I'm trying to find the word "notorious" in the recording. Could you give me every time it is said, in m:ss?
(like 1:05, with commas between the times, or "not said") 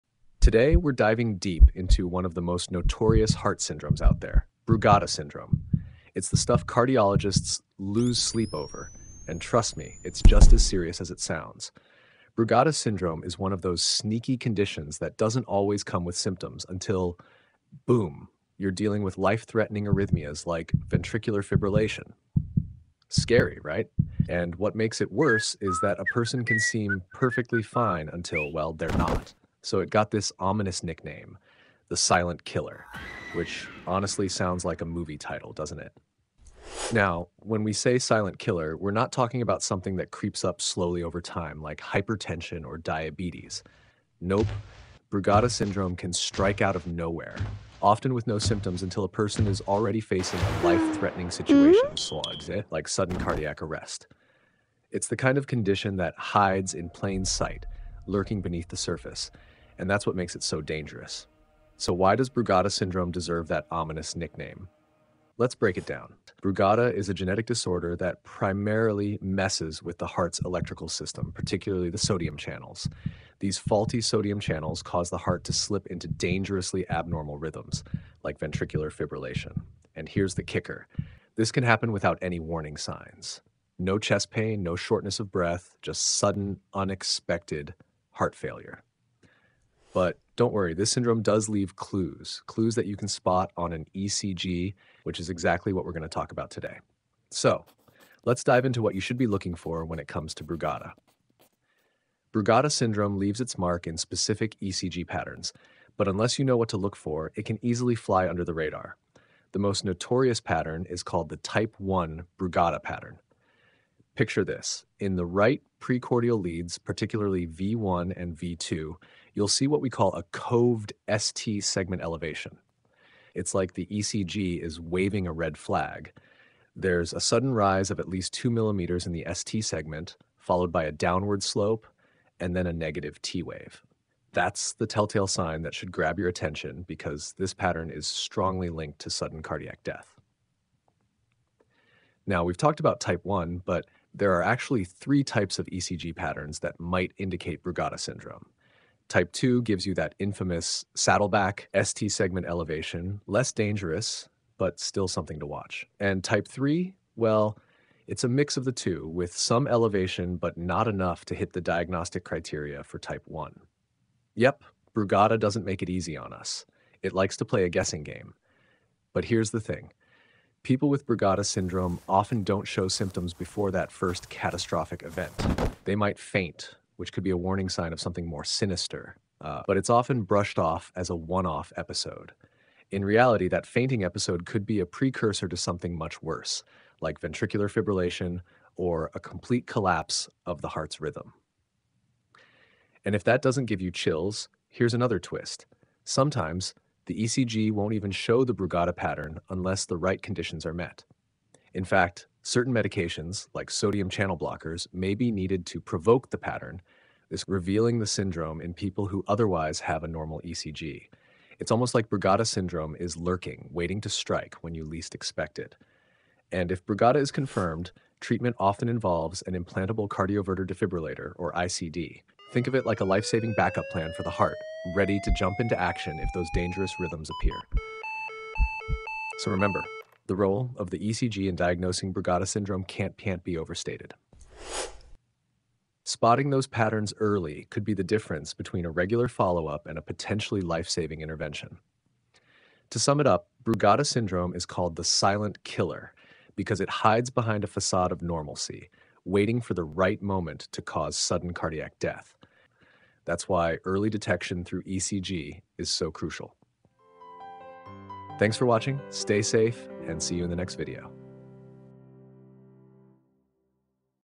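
0:02, 1:49.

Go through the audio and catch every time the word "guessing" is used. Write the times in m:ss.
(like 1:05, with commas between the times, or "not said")
2:47.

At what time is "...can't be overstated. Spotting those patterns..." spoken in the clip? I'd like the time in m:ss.
3:53.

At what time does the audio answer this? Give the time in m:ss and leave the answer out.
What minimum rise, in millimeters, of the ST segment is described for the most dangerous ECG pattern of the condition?
2:08.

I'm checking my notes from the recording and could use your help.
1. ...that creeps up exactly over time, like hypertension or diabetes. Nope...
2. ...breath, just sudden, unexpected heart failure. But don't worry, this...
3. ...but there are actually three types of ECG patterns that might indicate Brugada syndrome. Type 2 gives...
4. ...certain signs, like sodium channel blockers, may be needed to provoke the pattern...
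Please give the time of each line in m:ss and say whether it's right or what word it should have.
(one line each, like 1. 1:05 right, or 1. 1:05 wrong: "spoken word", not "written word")
1. 0:39 wrong: "slowly", not "exactly"
2. 1:25 right
3. 2:23 right
4. 3:22 wrong: "medications", not "signs".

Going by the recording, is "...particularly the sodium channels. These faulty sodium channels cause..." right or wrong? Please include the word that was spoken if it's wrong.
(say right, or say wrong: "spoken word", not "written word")
right.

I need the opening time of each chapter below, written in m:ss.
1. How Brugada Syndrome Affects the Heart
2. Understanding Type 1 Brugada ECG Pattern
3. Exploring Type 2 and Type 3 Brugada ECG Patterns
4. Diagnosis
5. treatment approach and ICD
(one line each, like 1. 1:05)
1. 1:06
2. 1:40
3. 2:23
4. 3:13
5. 3:38.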